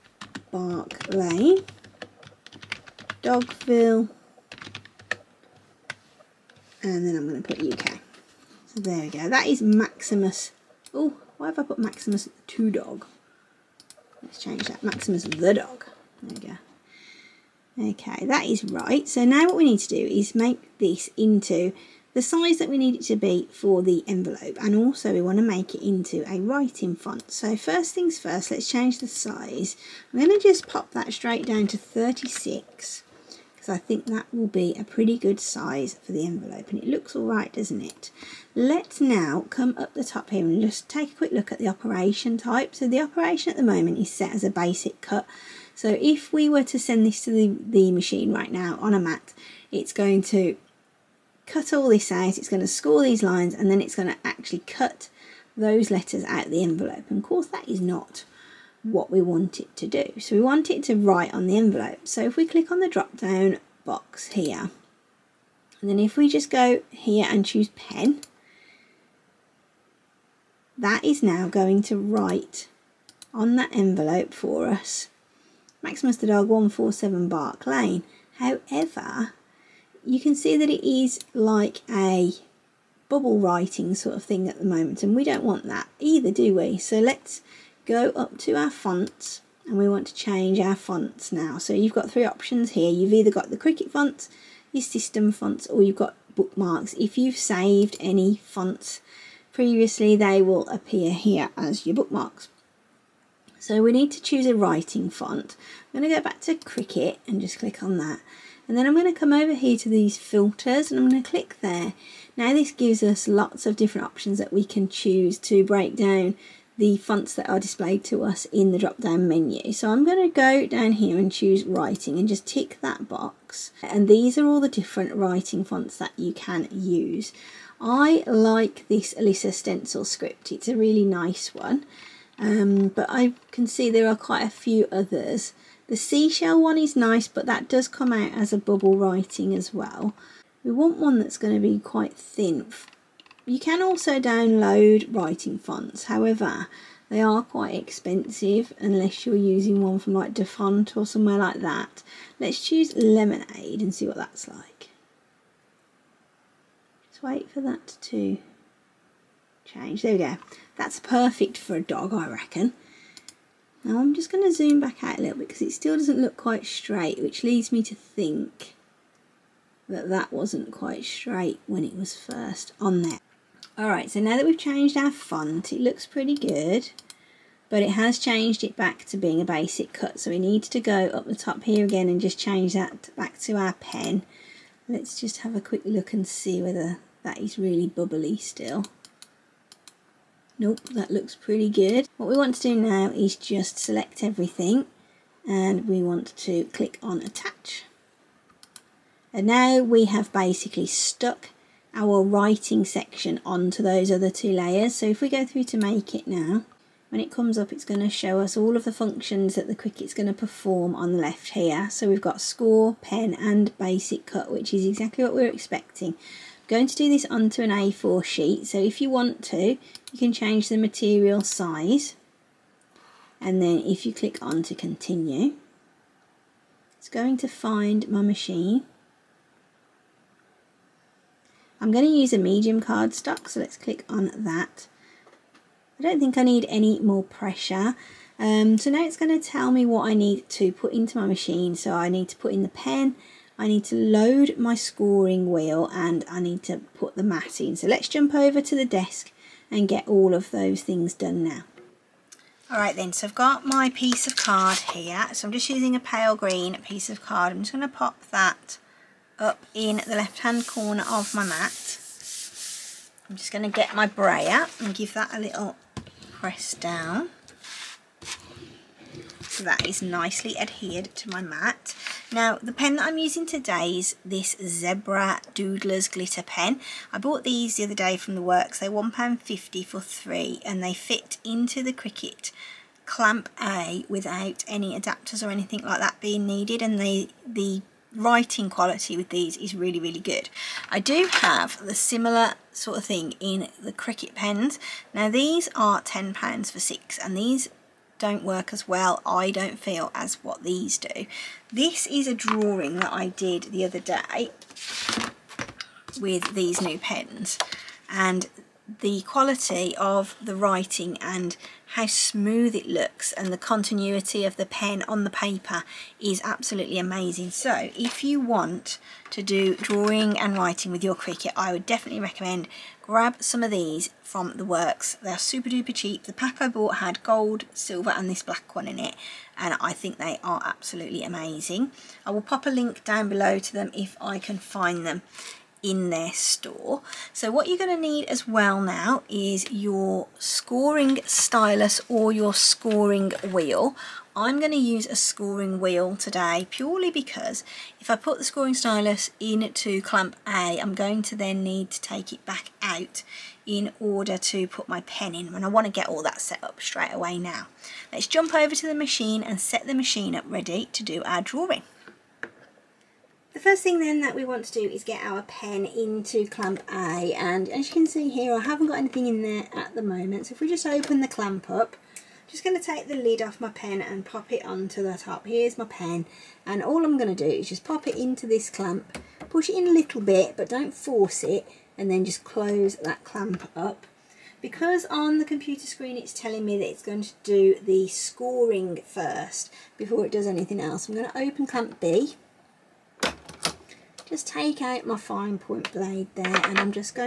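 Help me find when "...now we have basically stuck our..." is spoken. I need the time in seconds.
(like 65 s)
199 s.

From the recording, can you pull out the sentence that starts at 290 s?
I do have the similar sort of thing in the Cricut pens.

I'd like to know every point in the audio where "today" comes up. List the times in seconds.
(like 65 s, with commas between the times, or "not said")
273 s, 346 s.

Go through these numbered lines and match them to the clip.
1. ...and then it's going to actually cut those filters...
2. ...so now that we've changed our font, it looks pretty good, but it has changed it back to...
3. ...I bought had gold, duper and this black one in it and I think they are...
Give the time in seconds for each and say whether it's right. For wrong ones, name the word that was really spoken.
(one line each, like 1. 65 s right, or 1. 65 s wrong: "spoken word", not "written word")
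1. 53 s wrong: "letters", not "filters"
2. 174 s right
3. 326 s wrong: "silver", not "duper".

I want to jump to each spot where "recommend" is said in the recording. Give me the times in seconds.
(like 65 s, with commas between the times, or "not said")
322 s.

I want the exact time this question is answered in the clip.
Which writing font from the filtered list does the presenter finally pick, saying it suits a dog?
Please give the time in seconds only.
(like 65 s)
152 s.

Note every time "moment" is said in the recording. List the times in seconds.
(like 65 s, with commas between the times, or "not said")
43 s, 84 s, 370 s.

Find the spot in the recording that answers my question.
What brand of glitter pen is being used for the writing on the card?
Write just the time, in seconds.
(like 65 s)
274 s.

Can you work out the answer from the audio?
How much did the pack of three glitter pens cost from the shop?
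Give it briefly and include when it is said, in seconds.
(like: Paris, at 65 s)
£1.50, at 278 s.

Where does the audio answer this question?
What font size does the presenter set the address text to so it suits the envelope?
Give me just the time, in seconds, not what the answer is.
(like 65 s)
31 s.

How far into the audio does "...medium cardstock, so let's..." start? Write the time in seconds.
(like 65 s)
232 s.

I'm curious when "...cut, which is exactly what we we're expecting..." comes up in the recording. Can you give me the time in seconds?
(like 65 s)
214 s.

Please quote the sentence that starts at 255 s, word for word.
So I'm just using a pale green piece of card.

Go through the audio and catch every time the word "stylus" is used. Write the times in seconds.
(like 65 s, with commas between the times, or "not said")
341 s, 348 s.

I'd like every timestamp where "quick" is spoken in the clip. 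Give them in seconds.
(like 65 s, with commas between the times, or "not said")
41 s, 185 s.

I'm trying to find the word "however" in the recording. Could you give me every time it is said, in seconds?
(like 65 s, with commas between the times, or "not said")
78 s, 146 s.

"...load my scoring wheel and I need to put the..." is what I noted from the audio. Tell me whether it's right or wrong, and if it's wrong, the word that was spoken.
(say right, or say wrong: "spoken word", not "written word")
right.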